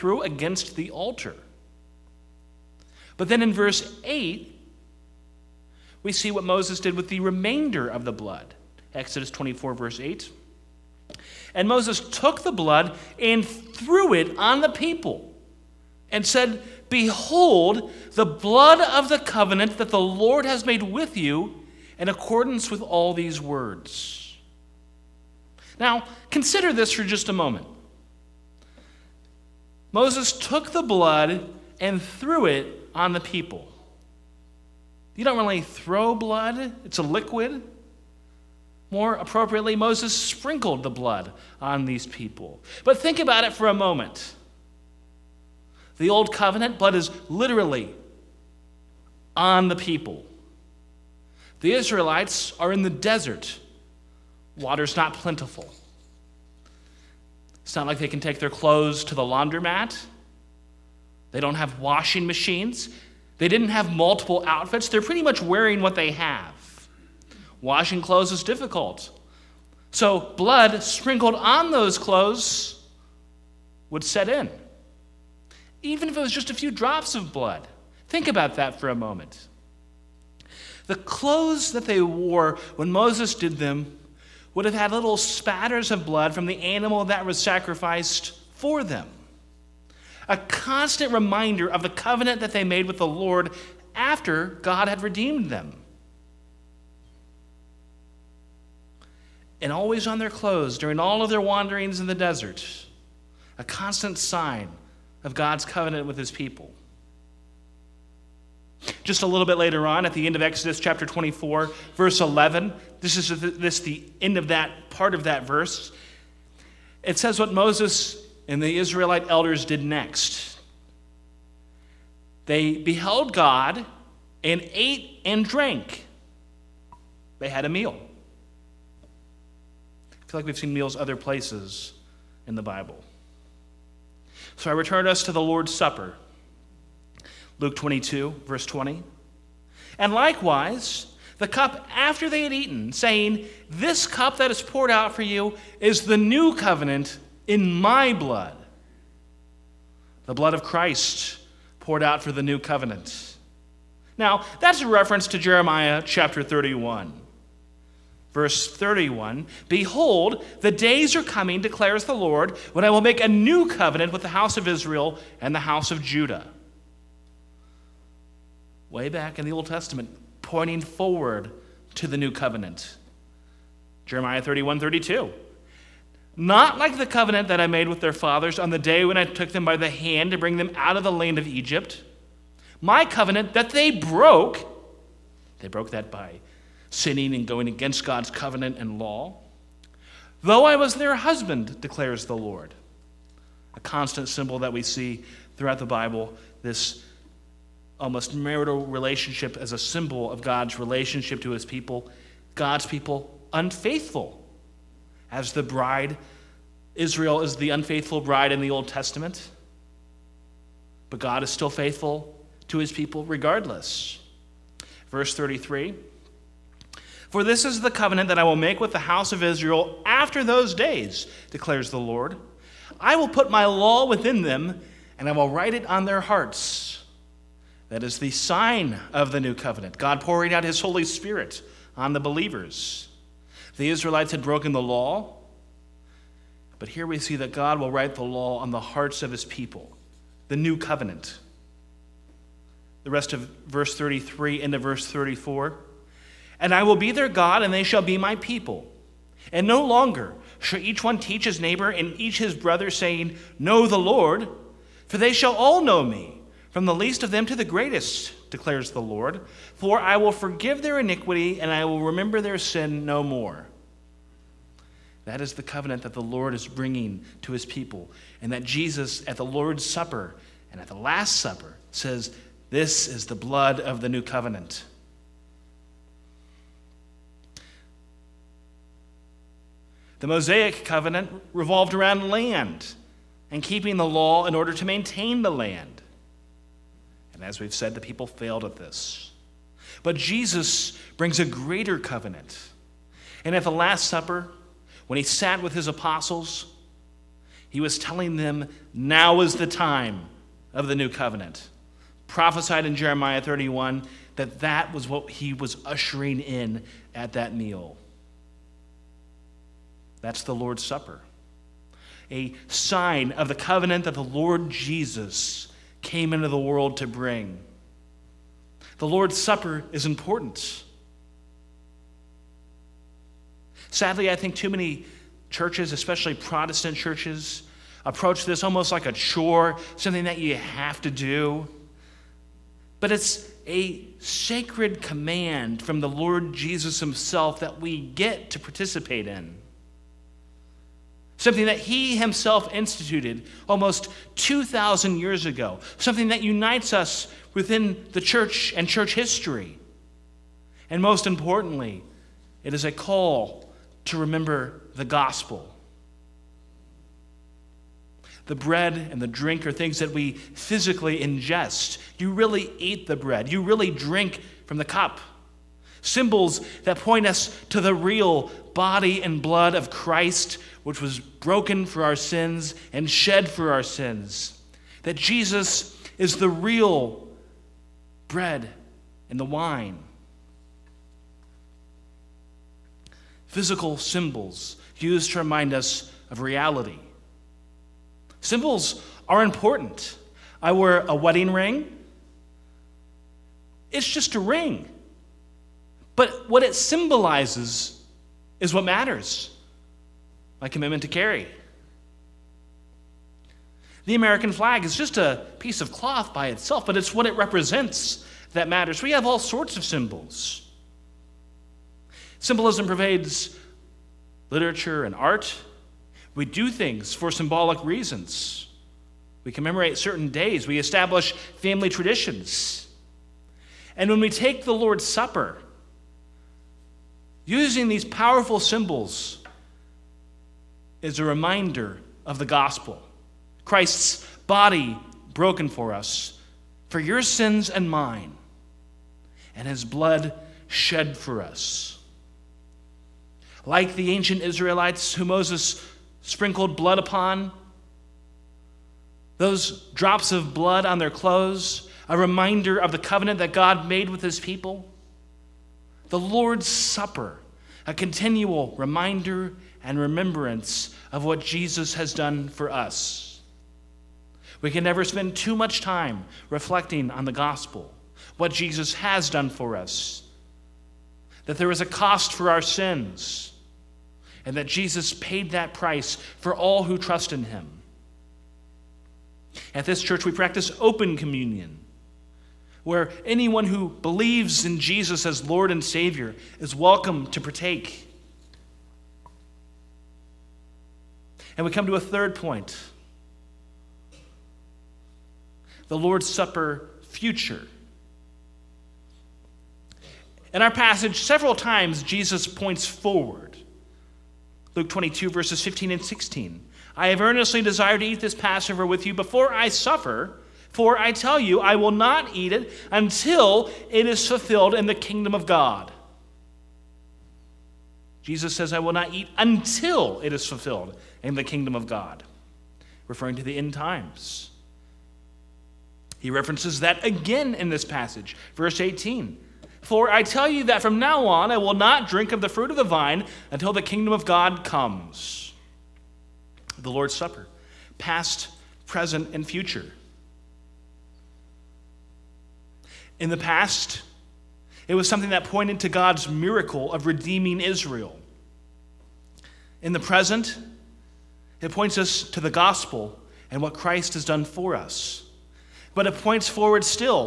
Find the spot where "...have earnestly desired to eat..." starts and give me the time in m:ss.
8:27.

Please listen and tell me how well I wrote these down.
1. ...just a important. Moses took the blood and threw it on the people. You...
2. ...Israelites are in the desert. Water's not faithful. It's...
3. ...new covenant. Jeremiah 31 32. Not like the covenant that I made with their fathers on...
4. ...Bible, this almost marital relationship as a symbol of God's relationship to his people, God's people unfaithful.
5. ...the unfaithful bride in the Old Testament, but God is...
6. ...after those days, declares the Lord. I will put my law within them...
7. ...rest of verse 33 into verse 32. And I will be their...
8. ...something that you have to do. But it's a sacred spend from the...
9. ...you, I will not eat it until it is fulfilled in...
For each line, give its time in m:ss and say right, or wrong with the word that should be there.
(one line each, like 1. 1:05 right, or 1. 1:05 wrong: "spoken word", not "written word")
1. 0:27 wrong: "moment", not "important"
2. 0:51 wrong: "plentiful", not "faithful"
3. 2:52 right
4. 3:15 right
5. 3:27 right
6. 3:40 right
7. 4:03 wrong: "34", not "32"
8. 5:29 wrong: "command", not "spend"
9. 8:31 right.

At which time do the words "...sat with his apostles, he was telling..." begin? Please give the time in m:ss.
4:55.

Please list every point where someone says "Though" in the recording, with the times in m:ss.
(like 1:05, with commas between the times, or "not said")
3:10.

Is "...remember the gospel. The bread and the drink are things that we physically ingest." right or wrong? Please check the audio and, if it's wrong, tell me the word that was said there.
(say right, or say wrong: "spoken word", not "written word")
right.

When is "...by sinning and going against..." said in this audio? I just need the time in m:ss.
3:06.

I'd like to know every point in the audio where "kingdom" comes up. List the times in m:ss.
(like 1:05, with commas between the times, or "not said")
8:34, 8:41, 8:53.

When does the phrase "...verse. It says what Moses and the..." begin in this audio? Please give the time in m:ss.
1:55.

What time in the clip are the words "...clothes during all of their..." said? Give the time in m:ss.
1:40.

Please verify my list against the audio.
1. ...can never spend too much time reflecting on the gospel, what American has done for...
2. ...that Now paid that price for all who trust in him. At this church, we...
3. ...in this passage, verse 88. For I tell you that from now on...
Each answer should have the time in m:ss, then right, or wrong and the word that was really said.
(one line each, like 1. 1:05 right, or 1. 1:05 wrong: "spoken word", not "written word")
1. 7:44 wrong: "Jesus", not "American"
2. 7:54 wrong: "Jesus", not "Now"
3. 8:47 wrong: "18", not "88".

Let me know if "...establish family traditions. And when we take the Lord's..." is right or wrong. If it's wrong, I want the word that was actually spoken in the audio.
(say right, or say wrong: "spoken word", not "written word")
right.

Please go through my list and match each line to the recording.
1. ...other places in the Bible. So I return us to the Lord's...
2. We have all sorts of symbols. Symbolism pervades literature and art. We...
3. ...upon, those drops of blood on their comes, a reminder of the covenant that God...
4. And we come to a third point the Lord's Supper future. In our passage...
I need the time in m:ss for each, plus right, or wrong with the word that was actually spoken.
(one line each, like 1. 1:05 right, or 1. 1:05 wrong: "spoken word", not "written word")
1. 2:10 right
2. 6:49 right
3. 7:26 wrong: "clothes", not "comes"
4. 8:11 right.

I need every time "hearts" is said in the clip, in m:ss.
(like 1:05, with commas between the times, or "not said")
3:46, 3:58.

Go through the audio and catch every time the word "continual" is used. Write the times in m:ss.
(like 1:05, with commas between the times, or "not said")
7:37.